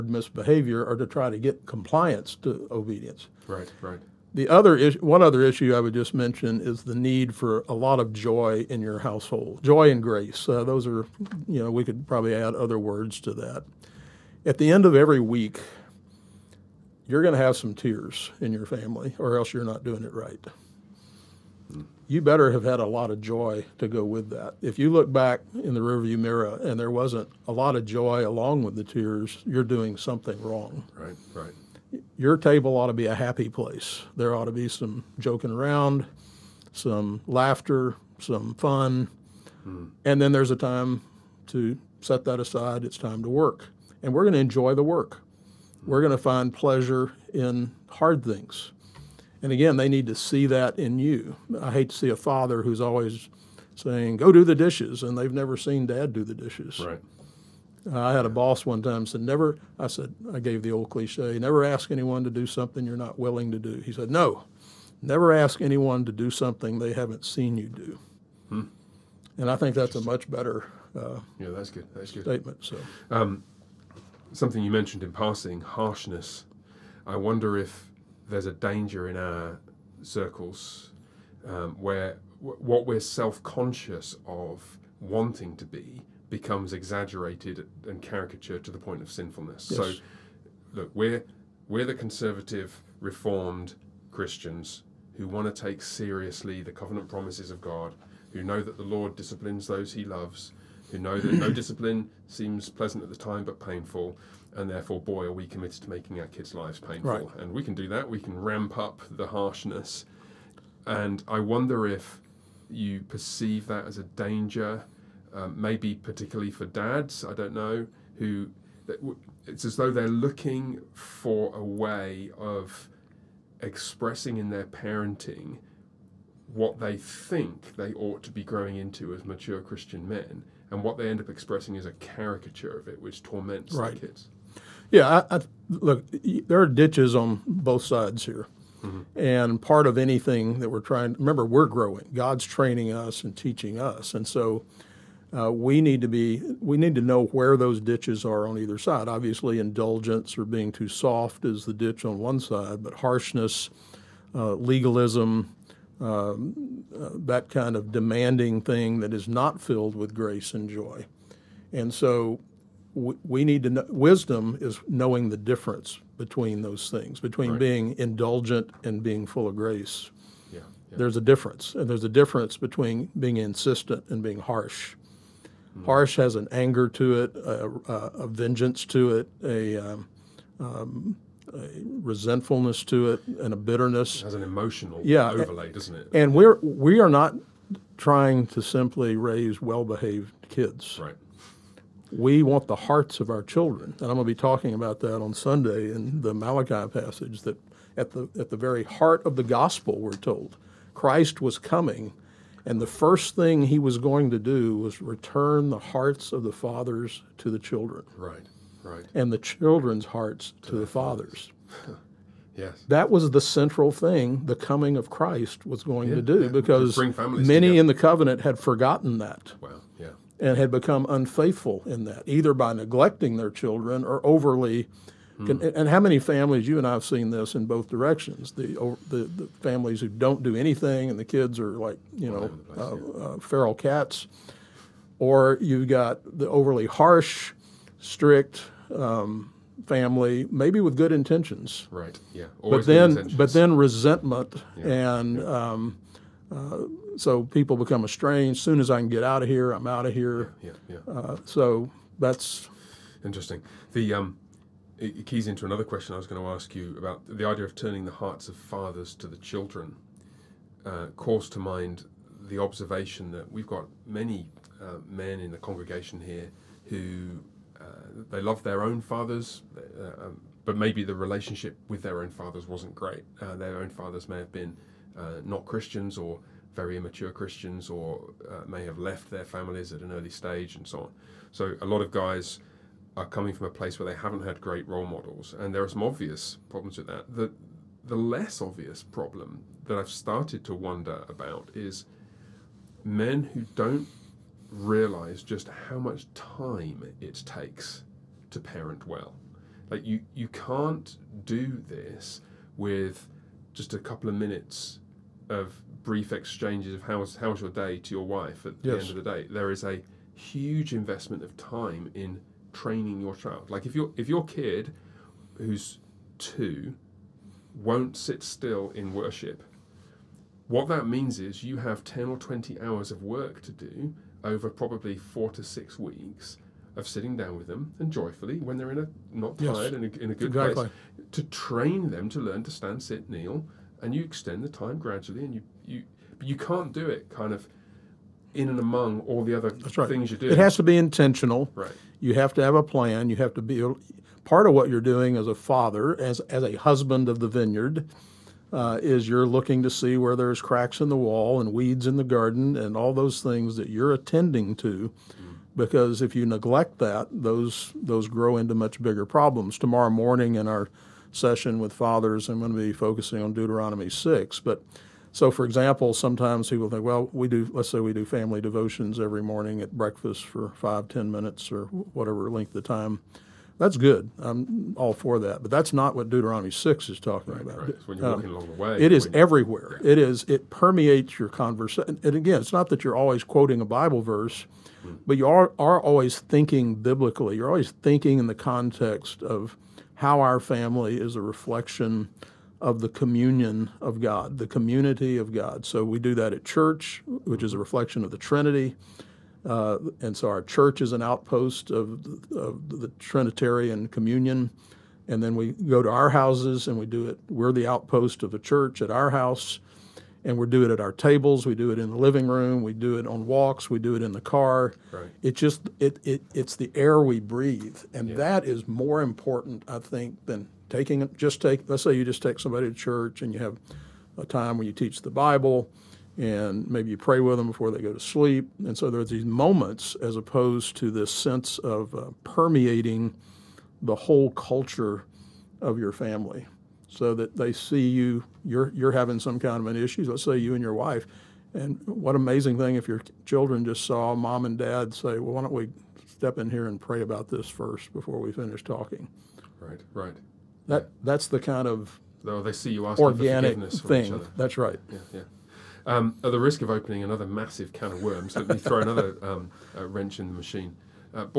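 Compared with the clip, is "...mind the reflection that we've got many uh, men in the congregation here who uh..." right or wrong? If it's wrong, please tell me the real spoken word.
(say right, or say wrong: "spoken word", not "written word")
wrong: "observation", not "reflection".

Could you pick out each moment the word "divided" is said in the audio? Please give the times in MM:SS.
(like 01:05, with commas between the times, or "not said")
not said.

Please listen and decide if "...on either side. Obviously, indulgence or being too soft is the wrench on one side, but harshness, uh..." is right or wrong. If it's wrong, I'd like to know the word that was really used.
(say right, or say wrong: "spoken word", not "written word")
wrong: "ditch", not "wrench".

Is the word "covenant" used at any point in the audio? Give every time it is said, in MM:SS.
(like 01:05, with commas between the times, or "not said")
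01:36, 03:37.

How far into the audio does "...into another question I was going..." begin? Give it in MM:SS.
04:15.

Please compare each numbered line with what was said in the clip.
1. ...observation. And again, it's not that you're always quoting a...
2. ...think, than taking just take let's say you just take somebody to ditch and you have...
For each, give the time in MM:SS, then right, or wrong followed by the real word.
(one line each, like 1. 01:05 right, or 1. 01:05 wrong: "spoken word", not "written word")
1. 06:21 wrong: "conversation", not "observation"
2. 06:59 wrong: "church", not "ditch".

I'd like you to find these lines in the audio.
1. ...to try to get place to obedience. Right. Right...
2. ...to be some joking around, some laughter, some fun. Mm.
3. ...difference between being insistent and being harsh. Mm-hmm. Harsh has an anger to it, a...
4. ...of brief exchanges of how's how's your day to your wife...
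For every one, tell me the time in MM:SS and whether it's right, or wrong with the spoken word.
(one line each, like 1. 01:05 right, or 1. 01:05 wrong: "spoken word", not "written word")
1. 00:00 wrong: "compliance", not "place"
2. 00:34 right
3. 02:52 right
4. 05:05 right.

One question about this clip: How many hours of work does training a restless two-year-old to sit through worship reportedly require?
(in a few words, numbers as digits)
10 to 20.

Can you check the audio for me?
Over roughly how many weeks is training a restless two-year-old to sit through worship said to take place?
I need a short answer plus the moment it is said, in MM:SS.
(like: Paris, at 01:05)
4 to 6 weeks, at 05:25.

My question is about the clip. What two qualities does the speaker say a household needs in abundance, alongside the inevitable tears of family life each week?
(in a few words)
joy and grace.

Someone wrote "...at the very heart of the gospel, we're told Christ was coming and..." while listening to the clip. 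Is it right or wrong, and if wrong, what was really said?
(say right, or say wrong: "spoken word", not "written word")
right.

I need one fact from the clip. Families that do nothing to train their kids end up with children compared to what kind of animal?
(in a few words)
feral cats.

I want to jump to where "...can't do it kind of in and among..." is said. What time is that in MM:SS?
05:36.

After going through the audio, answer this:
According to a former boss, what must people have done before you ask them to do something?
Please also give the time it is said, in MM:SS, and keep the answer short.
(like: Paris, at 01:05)
seen you do, at 01:07.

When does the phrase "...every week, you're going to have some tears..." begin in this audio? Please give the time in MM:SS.
00:14.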